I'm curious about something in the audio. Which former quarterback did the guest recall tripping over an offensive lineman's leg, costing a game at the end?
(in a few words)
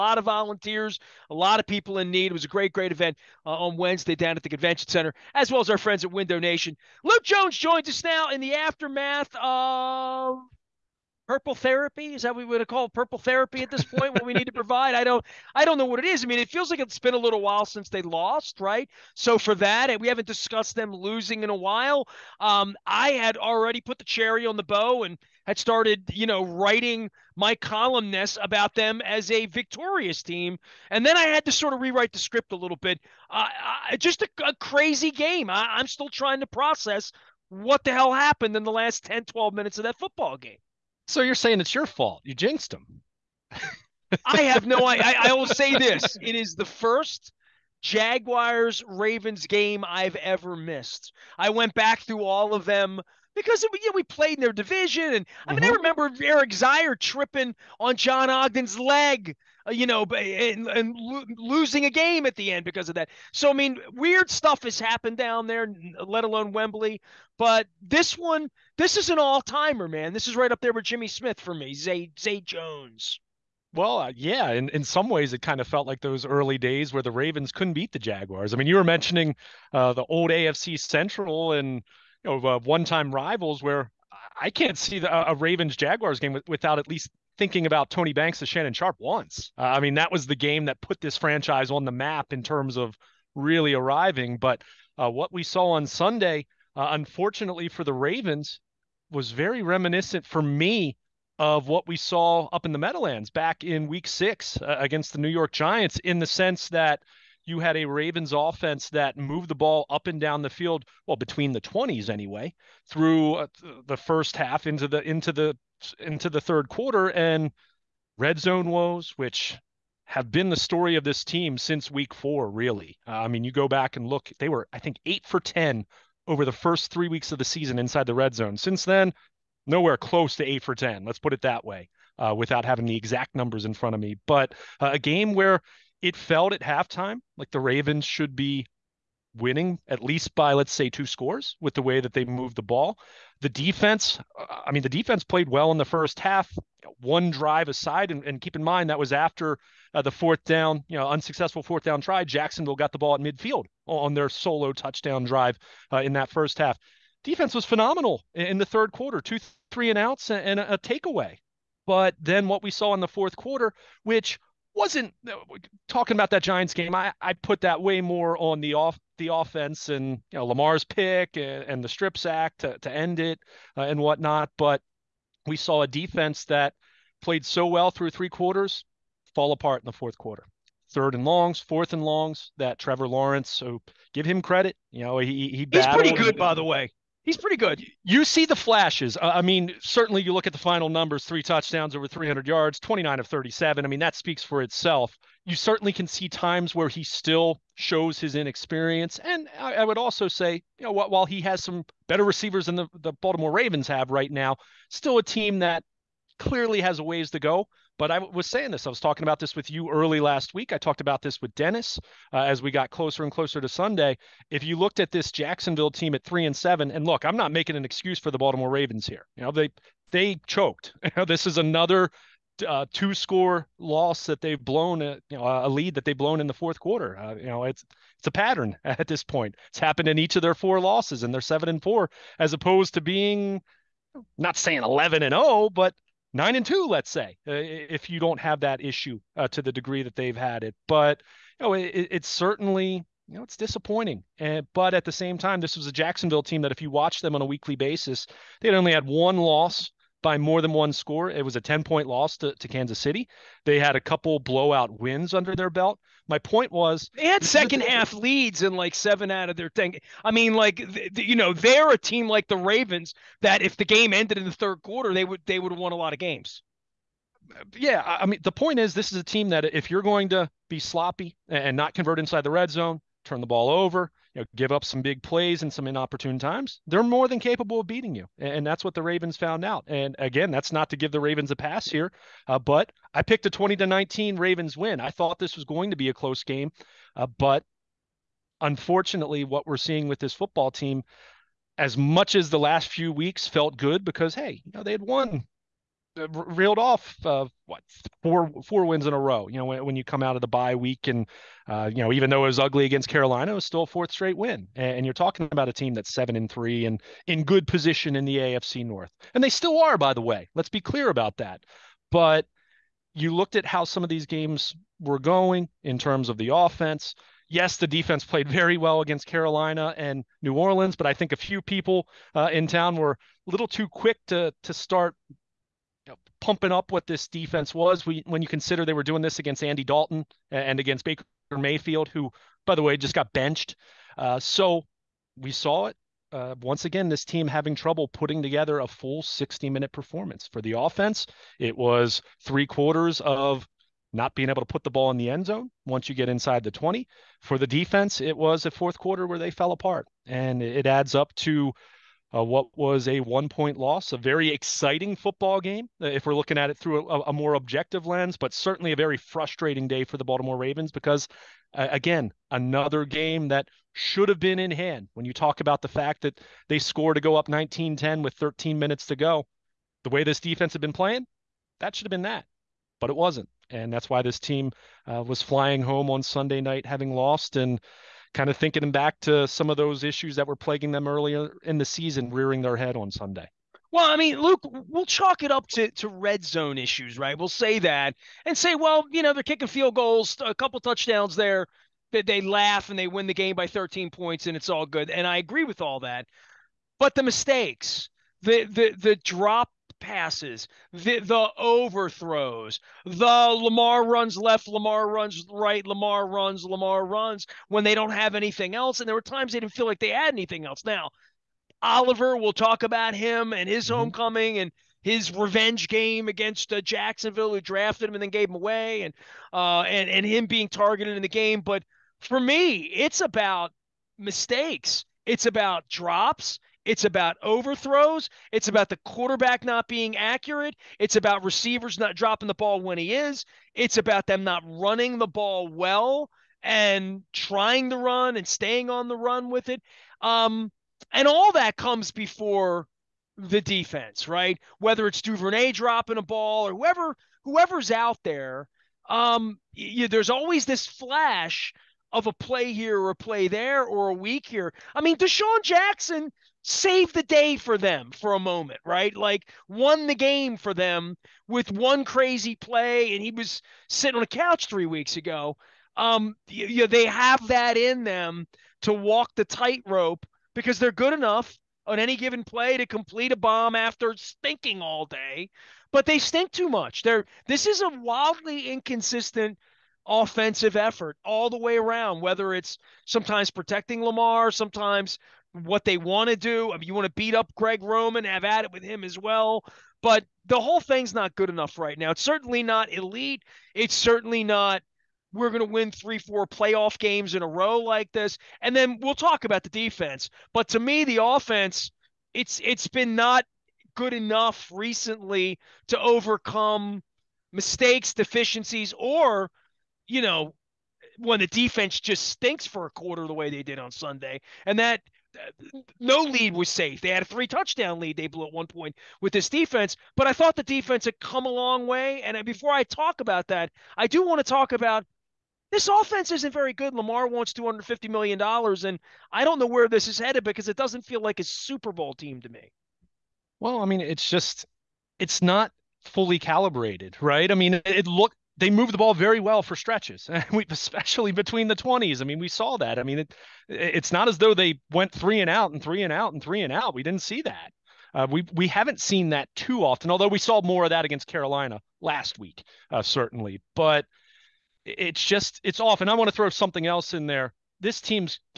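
Eric Zeier.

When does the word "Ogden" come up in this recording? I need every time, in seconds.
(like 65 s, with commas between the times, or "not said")
58 s.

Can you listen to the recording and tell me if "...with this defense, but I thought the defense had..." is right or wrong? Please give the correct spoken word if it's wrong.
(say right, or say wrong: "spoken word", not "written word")
right.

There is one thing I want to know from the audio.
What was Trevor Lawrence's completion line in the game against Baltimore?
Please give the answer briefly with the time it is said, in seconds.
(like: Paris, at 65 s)
29 of 37, at 192 s.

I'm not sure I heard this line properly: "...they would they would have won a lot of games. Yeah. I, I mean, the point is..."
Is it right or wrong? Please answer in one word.
right.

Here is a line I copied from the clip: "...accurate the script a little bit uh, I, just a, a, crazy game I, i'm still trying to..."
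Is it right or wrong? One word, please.
wrong.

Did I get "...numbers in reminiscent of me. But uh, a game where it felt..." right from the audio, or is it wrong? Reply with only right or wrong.
wrong.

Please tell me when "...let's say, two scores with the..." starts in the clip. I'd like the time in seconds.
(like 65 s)
140 s.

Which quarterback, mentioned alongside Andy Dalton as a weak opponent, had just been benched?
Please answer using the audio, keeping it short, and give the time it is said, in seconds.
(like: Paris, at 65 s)
Baker Mayfield, at 331 s.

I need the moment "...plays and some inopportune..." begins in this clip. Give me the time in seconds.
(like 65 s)
275 s.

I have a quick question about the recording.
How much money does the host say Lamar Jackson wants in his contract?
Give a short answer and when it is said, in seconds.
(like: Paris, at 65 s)
$250 million, at 527 s.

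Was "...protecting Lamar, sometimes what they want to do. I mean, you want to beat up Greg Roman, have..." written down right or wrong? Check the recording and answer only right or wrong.
right.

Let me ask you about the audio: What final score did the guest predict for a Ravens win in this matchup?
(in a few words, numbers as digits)
20 to 19.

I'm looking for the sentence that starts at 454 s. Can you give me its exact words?
I mean, DeSean Jackson saved the day for them for a moment, right?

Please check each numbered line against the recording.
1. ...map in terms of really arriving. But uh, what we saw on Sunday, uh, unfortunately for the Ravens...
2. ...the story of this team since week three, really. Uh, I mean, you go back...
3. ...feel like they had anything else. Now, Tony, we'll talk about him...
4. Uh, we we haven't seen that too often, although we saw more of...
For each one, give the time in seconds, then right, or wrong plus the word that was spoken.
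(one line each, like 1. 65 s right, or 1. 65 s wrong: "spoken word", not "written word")
1. 91 s right
2. 120 s wrong: "four", not "three"
3. 409 s wrong: "Oliver", not "Tony"
4. 548 s right.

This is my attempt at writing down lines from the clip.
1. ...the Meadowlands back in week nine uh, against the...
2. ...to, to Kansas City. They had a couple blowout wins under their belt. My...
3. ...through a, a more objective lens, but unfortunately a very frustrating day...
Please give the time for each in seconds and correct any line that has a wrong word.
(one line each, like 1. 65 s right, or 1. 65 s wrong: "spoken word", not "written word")
1. 102 s wrong: "six", not "nine"
2. 252 s right
3. 356 s wrong: "certainly", not "unfortunately".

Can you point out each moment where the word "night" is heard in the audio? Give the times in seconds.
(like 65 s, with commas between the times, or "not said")
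376 s.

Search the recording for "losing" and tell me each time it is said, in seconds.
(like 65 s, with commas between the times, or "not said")
20 s, 61 s.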